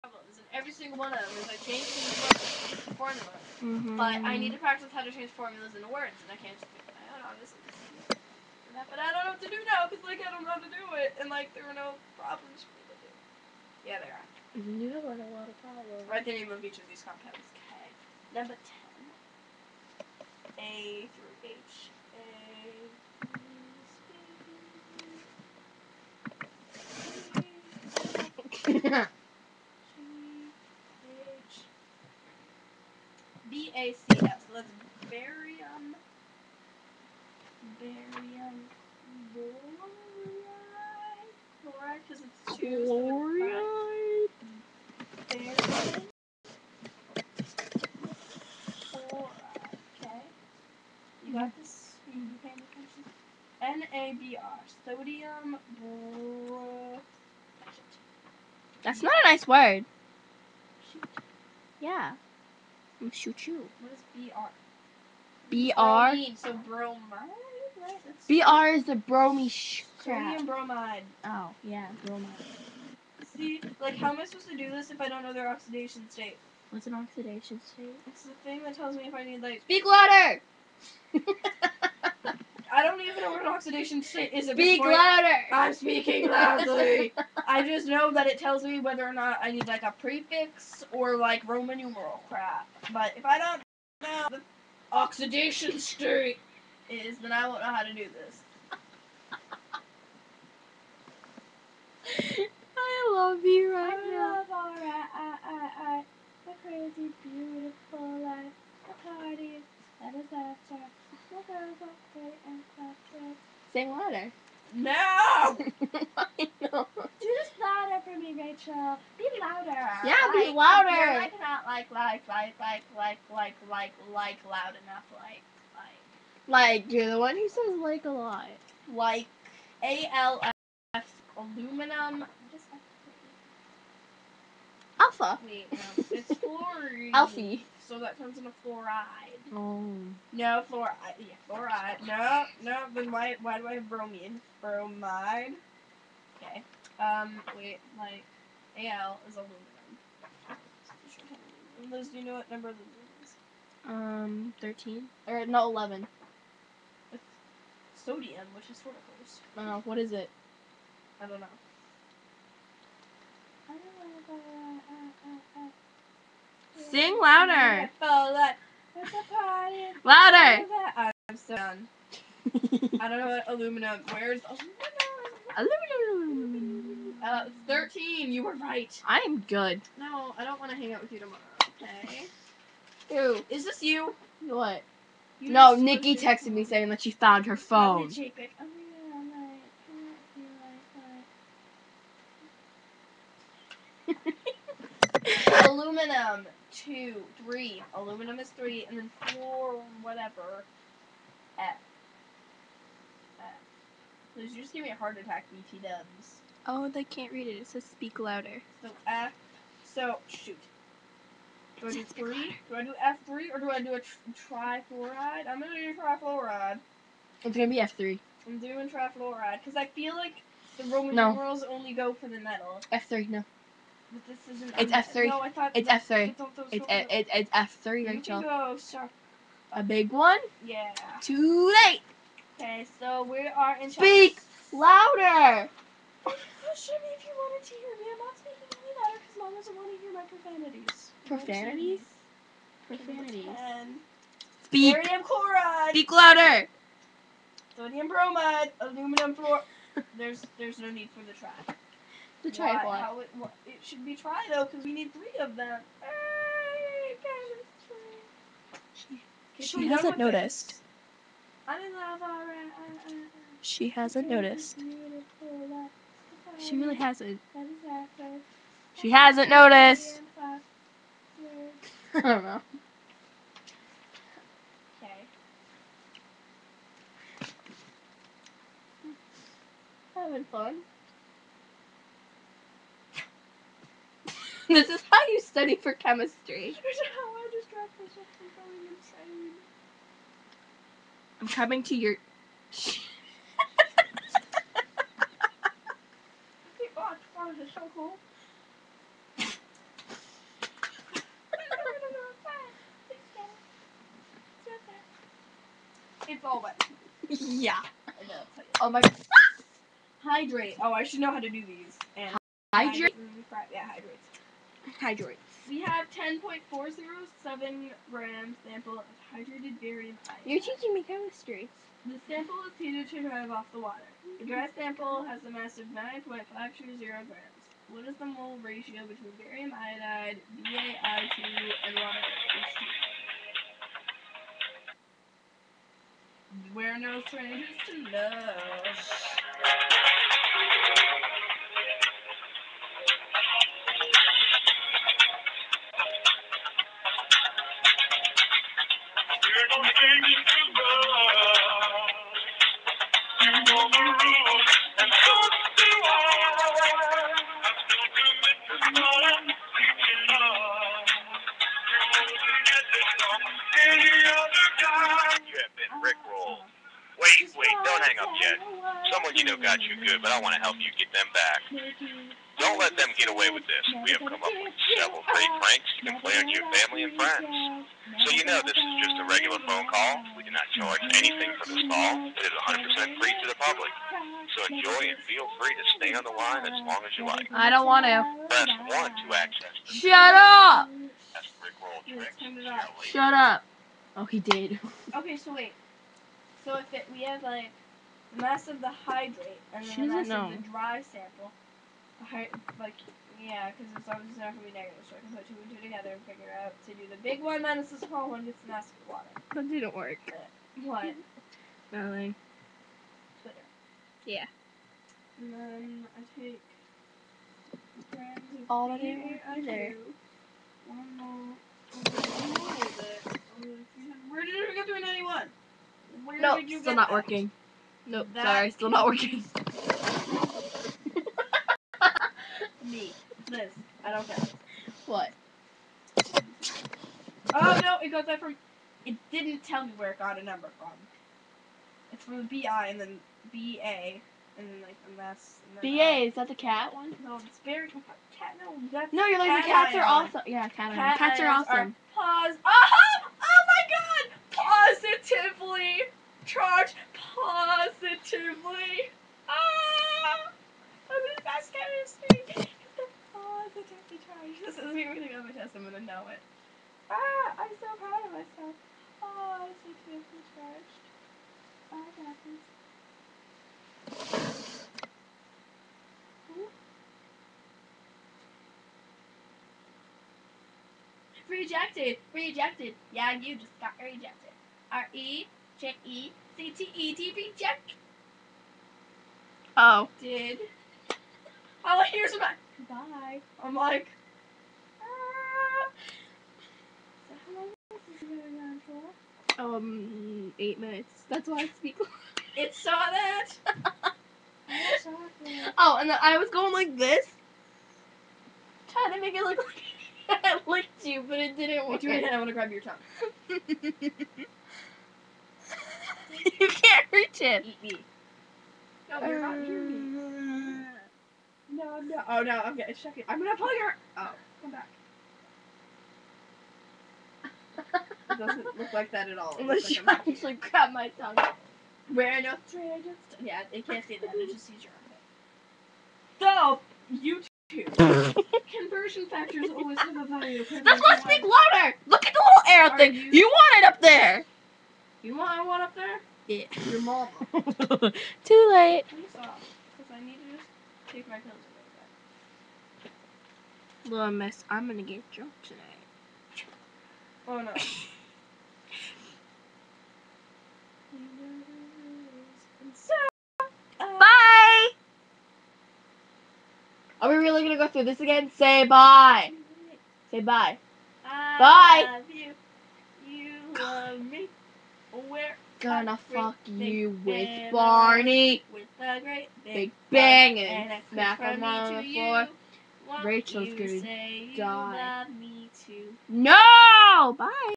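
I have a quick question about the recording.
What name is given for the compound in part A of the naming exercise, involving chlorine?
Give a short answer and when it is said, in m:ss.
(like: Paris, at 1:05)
Barium chloride, at 4:04.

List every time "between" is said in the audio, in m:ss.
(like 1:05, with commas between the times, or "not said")
5:29.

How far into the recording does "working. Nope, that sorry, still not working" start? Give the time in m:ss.
7:07.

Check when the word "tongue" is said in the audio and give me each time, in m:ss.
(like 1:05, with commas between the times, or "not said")
8:32, 8:51.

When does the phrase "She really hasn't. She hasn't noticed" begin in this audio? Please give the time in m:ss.
4:26.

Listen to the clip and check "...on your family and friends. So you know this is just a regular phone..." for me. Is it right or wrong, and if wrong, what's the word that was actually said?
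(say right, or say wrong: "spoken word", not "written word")
right.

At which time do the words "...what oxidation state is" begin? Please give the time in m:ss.
1:23.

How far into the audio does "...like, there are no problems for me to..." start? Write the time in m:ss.
0:11.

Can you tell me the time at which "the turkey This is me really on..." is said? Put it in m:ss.
7:43.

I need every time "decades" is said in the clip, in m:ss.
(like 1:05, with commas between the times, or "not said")
not said.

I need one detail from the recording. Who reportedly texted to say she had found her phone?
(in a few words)
Nikki.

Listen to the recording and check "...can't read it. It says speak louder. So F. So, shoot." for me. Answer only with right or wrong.
right.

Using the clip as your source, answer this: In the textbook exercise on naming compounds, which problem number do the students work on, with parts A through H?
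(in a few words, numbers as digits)
10.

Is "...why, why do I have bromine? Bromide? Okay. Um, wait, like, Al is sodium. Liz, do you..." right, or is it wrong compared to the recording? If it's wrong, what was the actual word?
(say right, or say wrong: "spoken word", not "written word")
wrong: "aluminum", not "sodium".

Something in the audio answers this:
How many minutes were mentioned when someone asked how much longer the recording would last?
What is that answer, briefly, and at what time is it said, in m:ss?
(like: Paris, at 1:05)
8 minutes, at 8:20.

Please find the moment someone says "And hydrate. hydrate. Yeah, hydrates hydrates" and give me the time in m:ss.
5:12.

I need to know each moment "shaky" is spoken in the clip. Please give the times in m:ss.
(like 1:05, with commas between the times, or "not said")
8:42.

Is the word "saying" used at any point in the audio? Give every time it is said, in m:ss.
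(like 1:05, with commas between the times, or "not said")
3:06.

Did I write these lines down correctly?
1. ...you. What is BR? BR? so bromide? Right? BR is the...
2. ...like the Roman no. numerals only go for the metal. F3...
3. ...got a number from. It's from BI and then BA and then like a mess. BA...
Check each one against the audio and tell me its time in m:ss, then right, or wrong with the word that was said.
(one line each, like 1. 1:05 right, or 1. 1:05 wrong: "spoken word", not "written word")
1. 1:03 right
2. 3:40 right
3. 7:20 right.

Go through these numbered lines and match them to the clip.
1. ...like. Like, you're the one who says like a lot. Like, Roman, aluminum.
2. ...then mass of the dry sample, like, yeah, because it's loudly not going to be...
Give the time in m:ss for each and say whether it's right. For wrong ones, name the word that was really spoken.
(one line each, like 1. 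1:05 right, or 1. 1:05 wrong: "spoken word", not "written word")
1. 2:05 wrong: "ALF", not "Roman"
2. 6:39 wrong: "obviously", not "loudly".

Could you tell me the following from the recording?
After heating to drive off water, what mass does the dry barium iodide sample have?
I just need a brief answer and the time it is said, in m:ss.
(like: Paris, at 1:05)
9.520 grams, at 5:25.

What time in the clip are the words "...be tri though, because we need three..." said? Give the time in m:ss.
4:14.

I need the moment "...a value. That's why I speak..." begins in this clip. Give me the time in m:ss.
9:00.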